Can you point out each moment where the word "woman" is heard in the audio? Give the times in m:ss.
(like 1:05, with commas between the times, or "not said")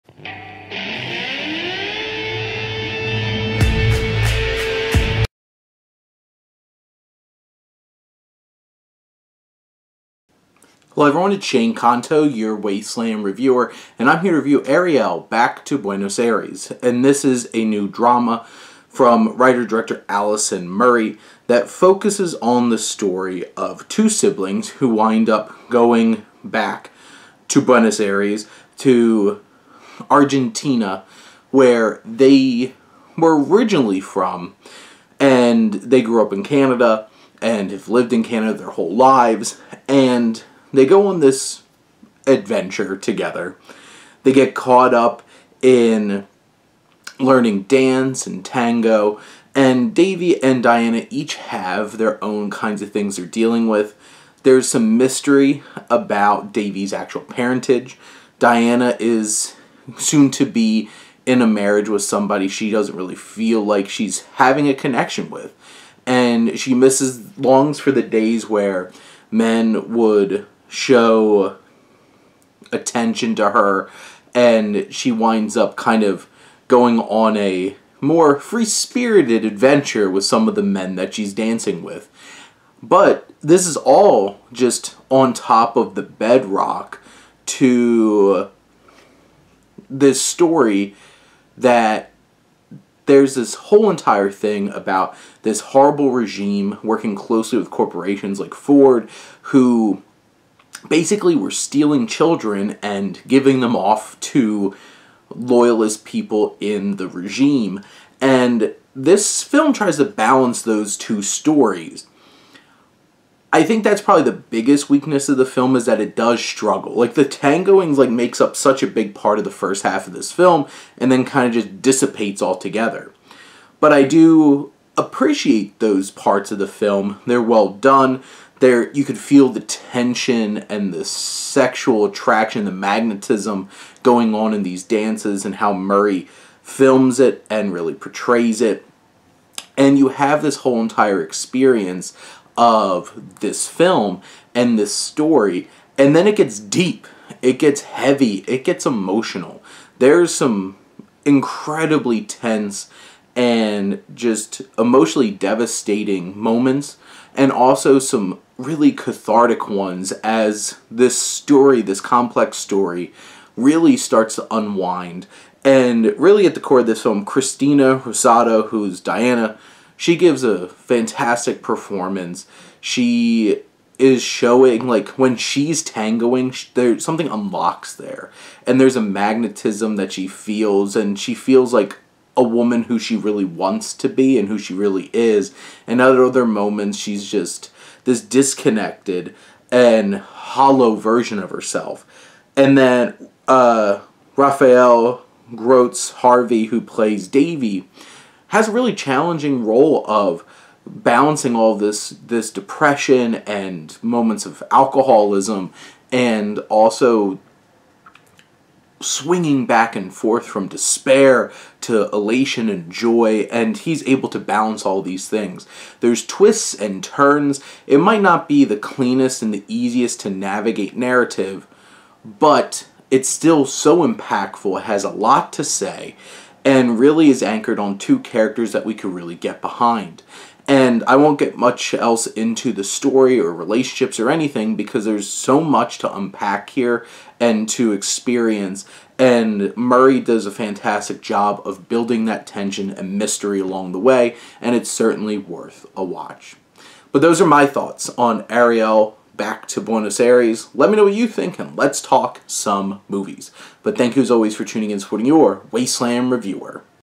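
3:02.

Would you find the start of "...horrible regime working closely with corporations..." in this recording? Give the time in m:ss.
1:35.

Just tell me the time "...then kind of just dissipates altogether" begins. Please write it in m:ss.
2:01.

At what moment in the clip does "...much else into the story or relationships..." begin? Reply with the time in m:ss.
3:51.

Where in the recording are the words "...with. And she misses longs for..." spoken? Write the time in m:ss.
1:05.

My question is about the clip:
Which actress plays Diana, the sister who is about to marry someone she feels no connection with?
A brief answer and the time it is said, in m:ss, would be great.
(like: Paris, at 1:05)
Cristina Rosato, at 2:47.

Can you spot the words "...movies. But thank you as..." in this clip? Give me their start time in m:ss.
4:13.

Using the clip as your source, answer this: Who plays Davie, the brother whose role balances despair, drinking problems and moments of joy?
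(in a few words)
Raphael Grosz-Harvey.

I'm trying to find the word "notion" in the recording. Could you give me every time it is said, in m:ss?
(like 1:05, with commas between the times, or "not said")
not said.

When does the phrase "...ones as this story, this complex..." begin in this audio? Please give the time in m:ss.
2:39.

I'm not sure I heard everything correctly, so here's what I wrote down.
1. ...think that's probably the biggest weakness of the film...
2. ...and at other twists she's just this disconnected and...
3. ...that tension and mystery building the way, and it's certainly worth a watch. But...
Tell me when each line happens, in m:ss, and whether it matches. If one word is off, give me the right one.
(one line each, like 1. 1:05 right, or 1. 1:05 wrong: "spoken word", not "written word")
1. 1:53 right
2. 3:05 wrong: "moments", not "twists"
3. 4:02 wrong: "along", not "building".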